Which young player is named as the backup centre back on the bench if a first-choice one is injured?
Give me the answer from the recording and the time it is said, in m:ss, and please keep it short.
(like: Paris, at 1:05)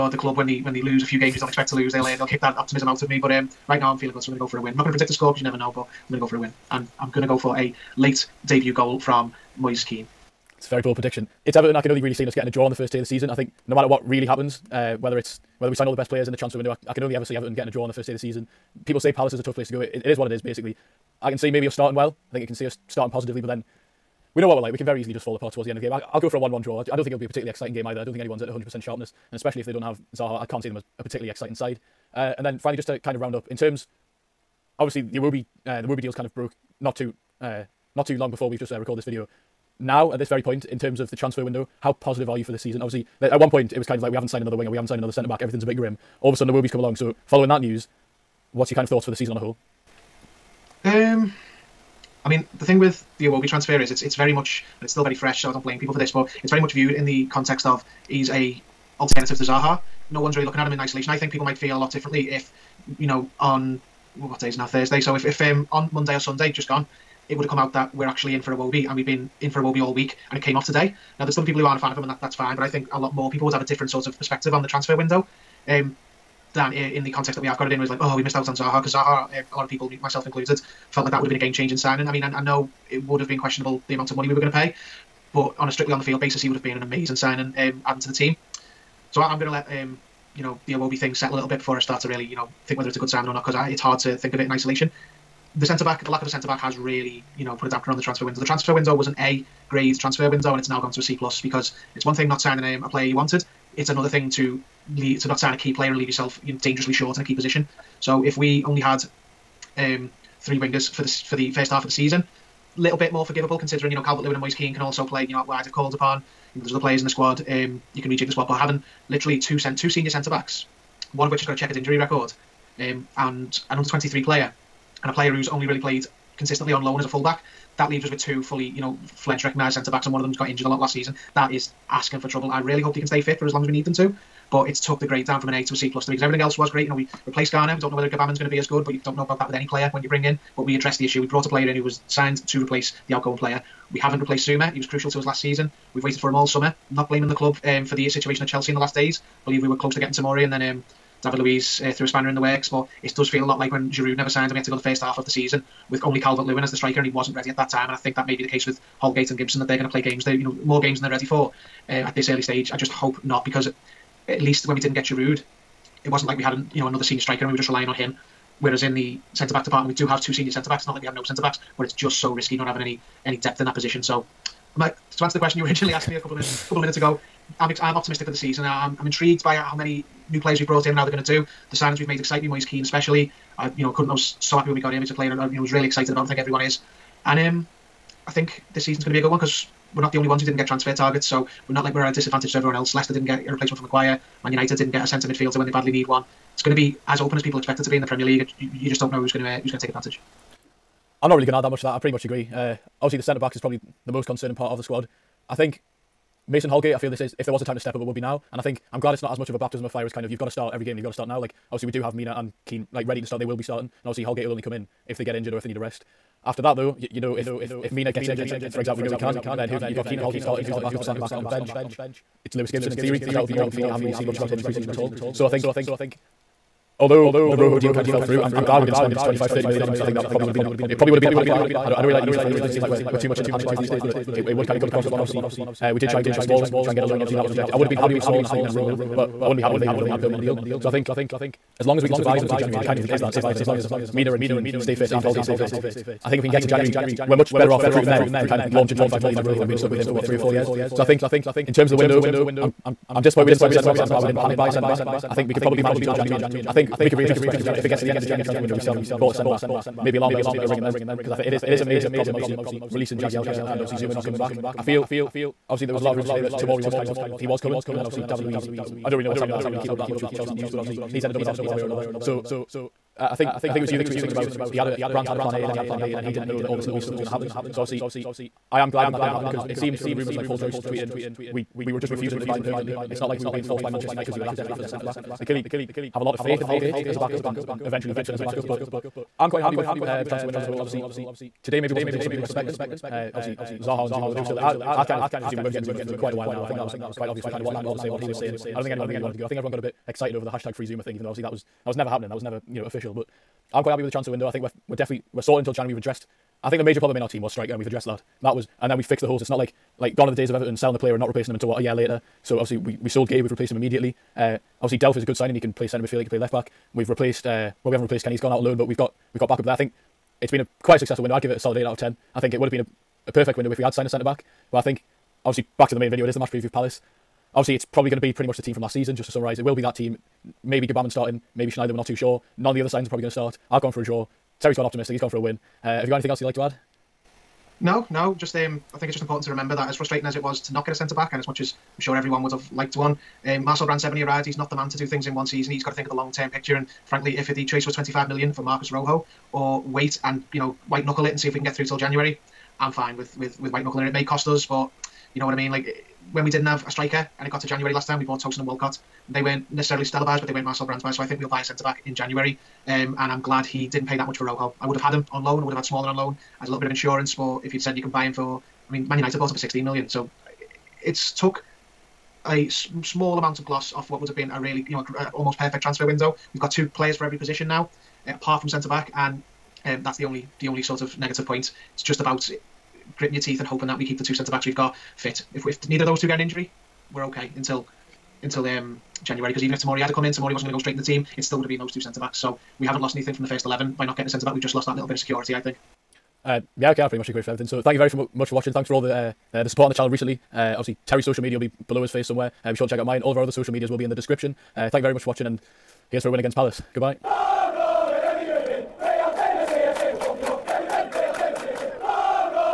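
Lewis Gibson, at 3:42.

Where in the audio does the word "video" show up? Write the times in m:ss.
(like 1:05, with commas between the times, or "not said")
0:39, 5:26.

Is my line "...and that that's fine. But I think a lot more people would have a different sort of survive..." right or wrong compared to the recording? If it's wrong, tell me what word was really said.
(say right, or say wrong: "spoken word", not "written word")
wrong: "perspective", not "survive".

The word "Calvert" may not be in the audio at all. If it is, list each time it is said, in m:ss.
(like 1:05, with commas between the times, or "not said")
1:54, 2:36.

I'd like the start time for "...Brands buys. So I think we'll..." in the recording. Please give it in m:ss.
6:00.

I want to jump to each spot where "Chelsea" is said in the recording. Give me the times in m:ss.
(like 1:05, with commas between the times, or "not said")
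2:28, 4:30.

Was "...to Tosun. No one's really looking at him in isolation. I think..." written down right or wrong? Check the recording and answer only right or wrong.
wrong.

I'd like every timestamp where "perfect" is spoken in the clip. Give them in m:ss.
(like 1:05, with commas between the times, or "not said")
5:23, 6:15.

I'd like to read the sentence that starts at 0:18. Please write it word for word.
People say Palace is a tough place to go.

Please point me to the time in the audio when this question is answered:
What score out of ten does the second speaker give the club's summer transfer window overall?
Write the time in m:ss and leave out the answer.
5:21.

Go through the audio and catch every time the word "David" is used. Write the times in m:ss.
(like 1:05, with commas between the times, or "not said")
2:31, 4:28.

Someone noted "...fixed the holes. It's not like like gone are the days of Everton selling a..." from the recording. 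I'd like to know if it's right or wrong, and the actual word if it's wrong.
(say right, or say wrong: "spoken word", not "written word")
right.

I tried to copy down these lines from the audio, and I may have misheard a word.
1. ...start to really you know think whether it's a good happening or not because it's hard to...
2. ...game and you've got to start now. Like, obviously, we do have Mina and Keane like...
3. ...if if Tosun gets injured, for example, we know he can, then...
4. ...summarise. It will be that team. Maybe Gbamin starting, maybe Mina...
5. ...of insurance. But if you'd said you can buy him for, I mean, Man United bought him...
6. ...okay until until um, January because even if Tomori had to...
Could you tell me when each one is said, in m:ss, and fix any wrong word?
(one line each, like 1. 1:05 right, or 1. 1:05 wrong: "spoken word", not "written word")
1. 1:31 wrong: "signing", not "happening"
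2. 3:30 right
3. 3:37 wrong: "Mina", not "Tosun"
4. 5:29 wrong: "Schneider", not "Mina"
5. 6:06 right
6. 6:27 right.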